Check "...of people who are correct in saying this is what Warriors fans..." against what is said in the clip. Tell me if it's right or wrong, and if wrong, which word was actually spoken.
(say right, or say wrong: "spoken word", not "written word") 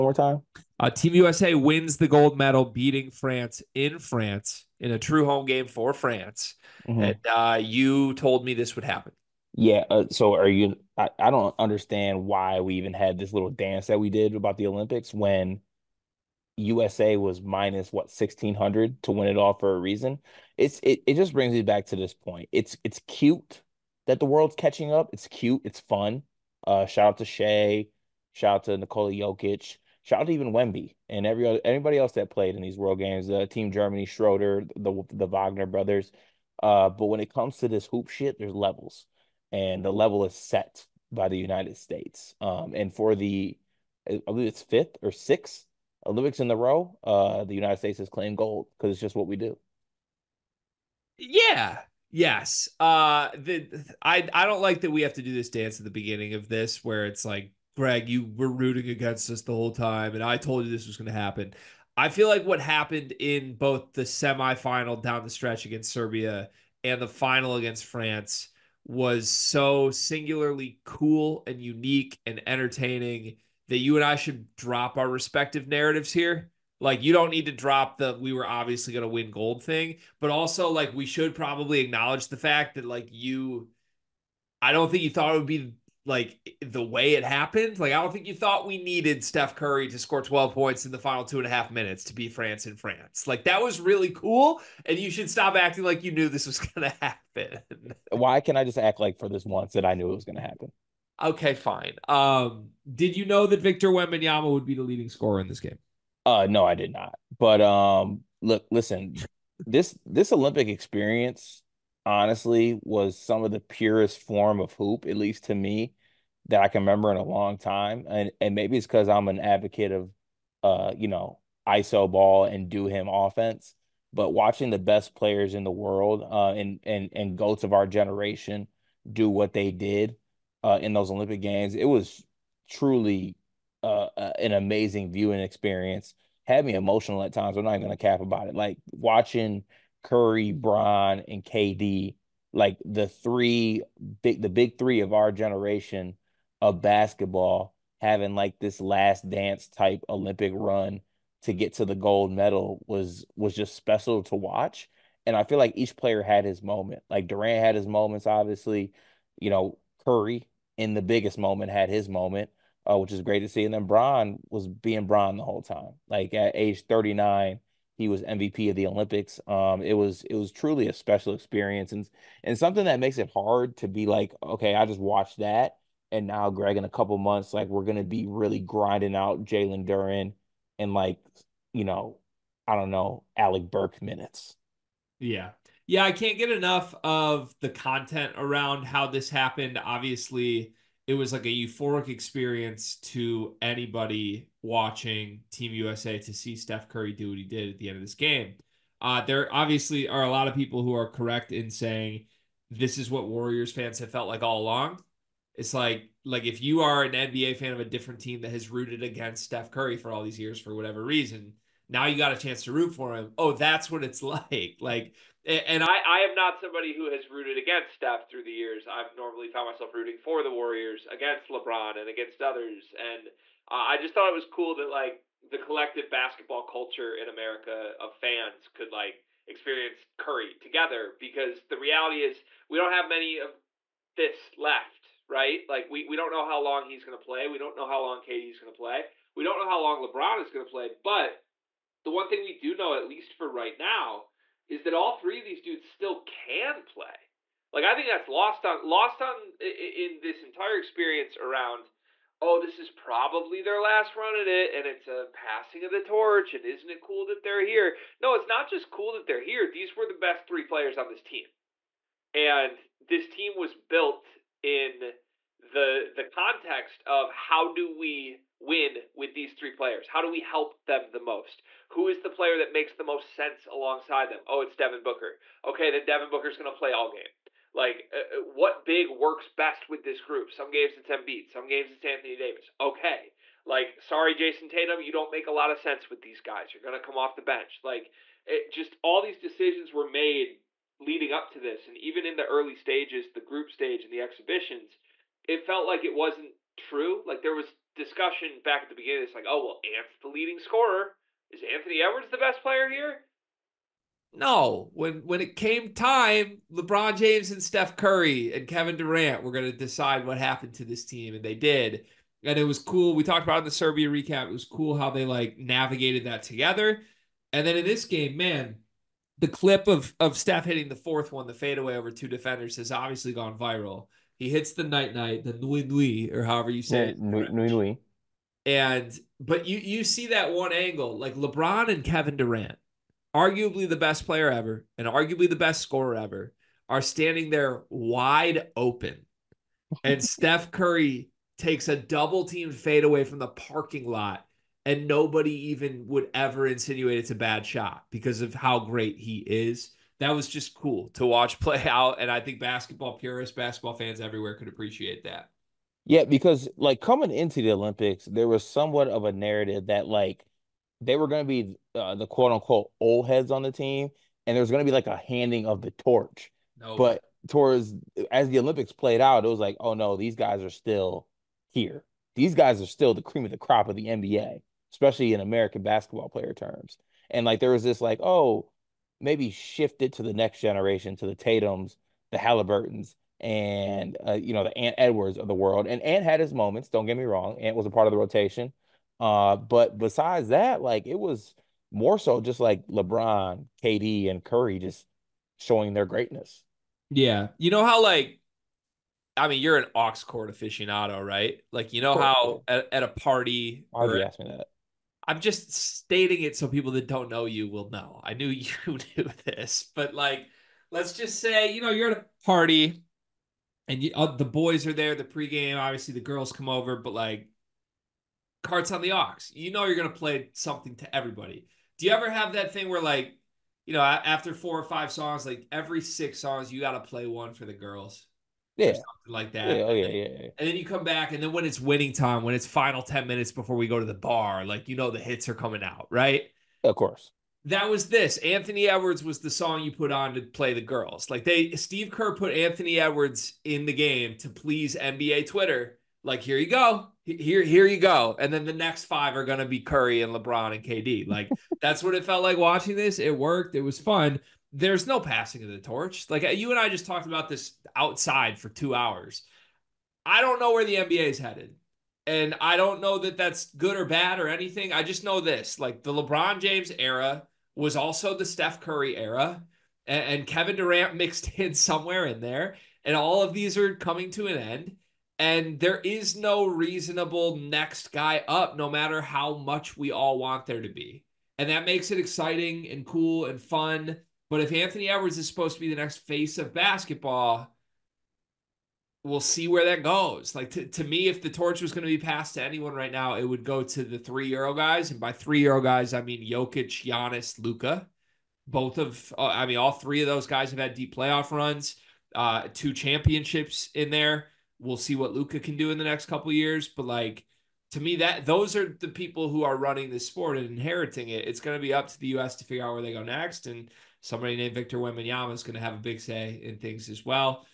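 right.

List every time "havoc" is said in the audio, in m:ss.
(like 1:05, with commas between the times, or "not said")
not said.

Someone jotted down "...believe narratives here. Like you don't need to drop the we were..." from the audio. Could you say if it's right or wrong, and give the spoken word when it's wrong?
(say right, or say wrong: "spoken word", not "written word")
wrong: "respective", not "believe".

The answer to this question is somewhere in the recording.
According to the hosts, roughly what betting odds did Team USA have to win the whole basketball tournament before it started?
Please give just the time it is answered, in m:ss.
0:17.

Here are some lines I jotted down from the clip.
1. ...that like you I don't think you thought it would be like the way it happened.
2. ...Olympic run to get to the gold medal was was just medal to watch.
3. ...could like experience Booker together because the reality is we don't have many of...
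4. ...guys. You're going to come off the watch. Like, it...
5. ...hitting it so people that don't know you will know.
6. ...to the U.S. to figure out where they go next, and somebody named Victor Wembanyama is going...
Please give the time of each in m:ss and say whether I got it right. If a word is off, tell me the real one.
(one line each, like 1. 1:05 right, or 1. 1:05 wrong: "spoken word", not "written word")
1. 1:22 right
2. 2:30 wrong: "special", not "medal"
3. 3:48 wrong: "Curry", not "Booker"
4. 4:46 wrong: "bench", not "watch"
5. 6:45 wrong: "stating", not "hitting"
6. 8:32 right.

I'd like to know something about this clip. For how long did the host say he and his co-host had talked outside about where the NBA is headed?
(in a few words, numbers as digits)
2 hours.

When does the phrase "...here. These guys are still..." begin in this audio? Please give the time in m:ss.
6:11.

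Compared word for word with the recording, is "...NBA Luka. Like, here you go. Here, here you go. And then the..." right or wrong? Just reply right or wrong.
wrong.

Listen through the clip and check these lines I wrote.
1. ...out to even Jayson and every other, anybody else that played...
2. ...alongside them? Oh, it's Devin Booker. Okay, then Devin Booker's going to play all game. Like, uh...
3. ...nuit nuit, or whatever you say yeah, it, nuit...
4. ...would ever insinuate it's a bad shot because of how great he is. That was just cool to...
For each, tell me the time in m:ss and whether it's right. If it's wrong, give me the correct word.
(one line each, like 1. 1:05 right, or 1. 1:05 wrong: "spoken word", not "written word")
1. 0:30 wrong: "Wemby", not "Jayson"
2. 4:33 right
3. 5:25 wrong: "however", not "whatever"
4. 5:46 right.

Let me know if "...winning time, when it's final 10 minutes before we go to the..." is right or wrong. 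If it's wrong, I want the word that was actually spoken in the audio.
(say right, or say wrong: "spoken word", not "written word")
right.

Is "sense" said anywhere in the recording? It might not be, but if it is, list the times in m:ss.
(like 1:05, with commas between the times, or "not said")
4:33, 4:45.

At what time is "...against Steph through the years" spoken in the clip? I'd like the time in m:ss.
3:37.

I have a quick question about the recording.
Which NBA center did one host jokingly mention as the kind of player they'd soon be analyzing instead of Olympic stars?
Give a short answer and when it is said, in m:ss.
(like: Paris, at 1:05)
Jalen Duren, at 2:59.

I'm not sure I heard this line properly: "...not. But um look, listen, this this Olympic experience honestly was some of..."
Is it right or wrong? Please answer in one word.
right.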